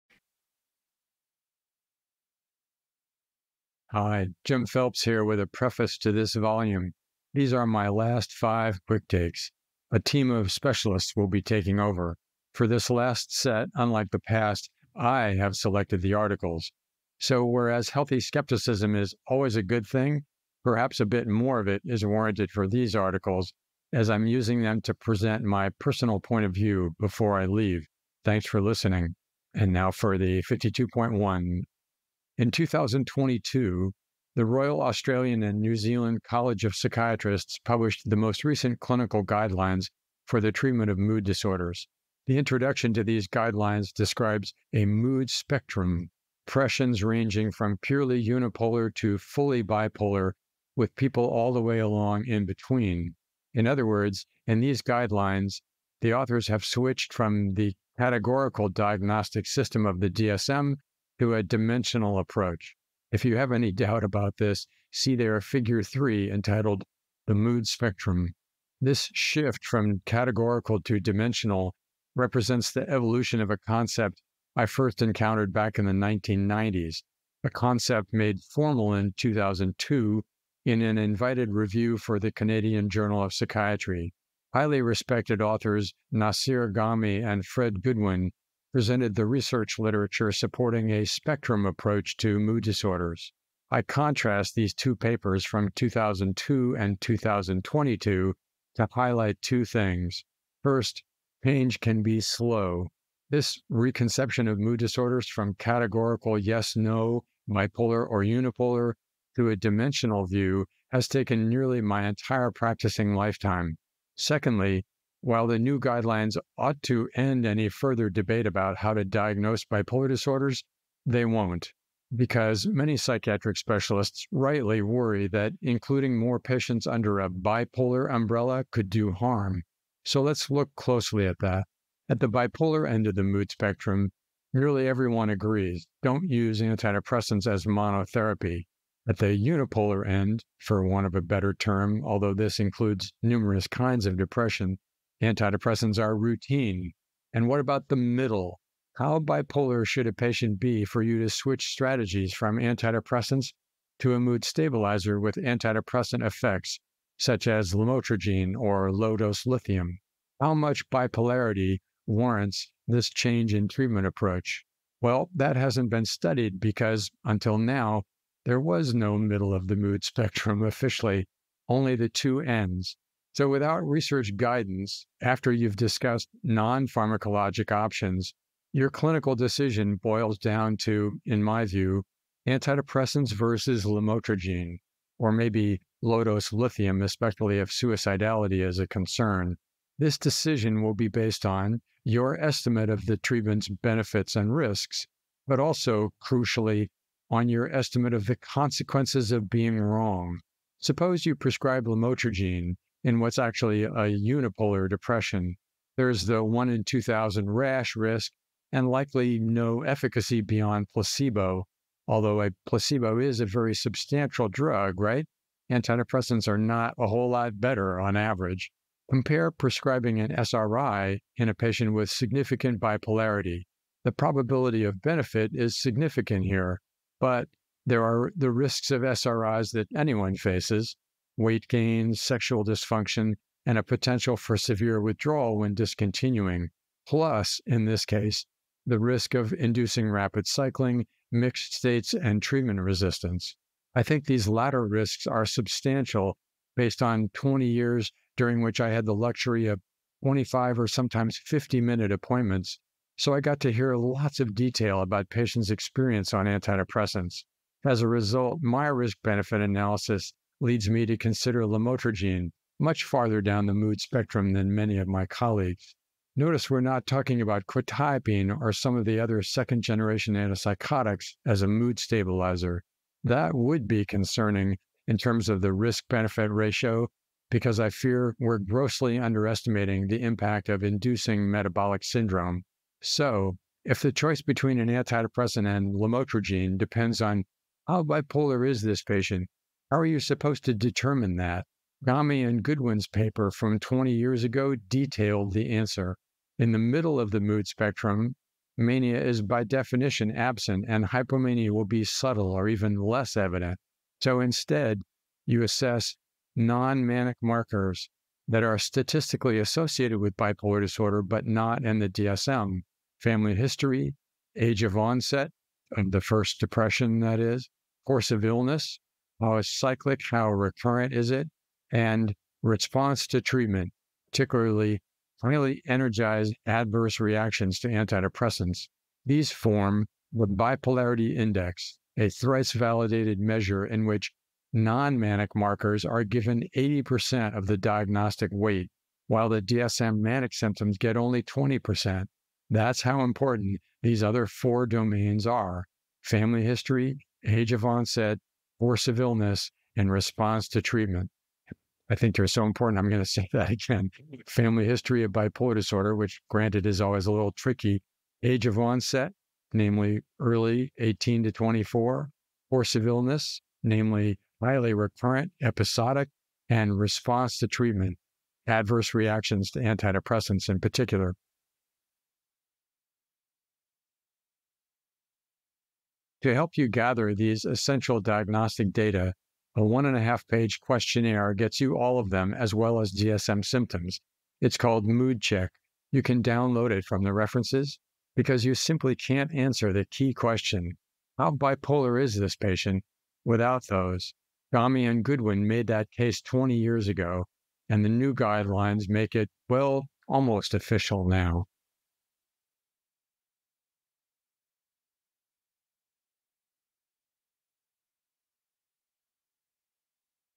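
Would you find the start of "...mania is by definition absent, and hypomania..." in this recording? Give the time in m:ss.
4:58.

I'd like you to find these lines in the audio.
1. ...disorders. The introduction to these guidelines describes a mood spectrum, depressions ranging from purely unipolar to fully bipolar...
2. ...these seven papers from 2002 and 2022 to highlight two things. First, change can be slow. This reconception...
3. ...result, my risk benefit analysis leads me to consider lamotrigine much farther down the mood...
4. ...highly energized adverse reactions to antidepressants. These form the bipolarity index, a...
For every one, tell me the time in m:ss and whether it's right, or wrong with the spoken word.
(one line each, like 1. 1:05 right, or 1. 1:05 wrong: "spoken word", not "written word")
1. 0:41 right
2. 1:34 wrong: "two", not "seven"
3. 4:18 right
4. 5:25 right.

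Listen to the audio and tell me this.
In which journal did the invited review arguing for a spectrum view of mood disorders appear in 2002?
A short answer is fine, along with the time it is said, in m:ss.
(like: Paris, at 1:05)
Canadian Journal of Psychiatry, at 1:22.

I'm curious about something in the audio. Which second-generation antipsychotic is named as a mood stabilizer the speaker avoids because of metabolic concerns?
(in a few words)
quetiapine.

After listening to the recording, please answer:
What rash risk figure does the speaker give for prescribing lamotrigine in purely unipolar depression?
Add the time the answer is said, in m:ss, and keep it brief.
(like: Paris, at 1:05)
1 in 2000, at 3:26.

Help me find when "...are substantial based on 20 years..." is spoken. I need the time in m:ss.
4:05.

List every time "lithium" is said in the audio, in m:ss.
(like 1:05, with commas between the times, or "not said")
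2:39, 3:06.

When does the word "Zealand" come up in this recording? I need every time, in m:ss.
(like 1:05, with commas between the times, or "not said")
0:35.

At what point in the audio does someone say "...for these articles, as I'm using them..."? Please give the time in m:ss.
0:22.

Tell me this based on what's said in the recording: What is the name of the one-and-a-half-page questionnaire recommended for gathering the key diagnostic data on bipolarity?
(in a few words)
Mood Check.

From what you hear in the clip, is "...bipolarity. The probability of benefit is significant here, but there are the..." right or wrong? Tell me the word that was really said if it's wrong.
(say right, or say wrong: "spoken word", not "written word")
right.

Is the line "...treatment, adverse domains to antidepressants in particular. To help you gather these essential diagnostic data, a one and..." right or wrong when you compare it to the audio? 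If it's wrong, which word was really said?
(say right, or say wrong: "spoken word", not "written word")
wrong: "reactions", not "domains".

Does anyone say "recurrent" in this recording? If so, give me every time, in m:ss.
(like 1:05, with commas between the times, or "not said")
5:20, 6:04.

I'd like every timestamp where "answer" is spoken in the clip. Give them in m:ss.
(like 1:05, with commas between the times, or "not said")
4:55, 6:29.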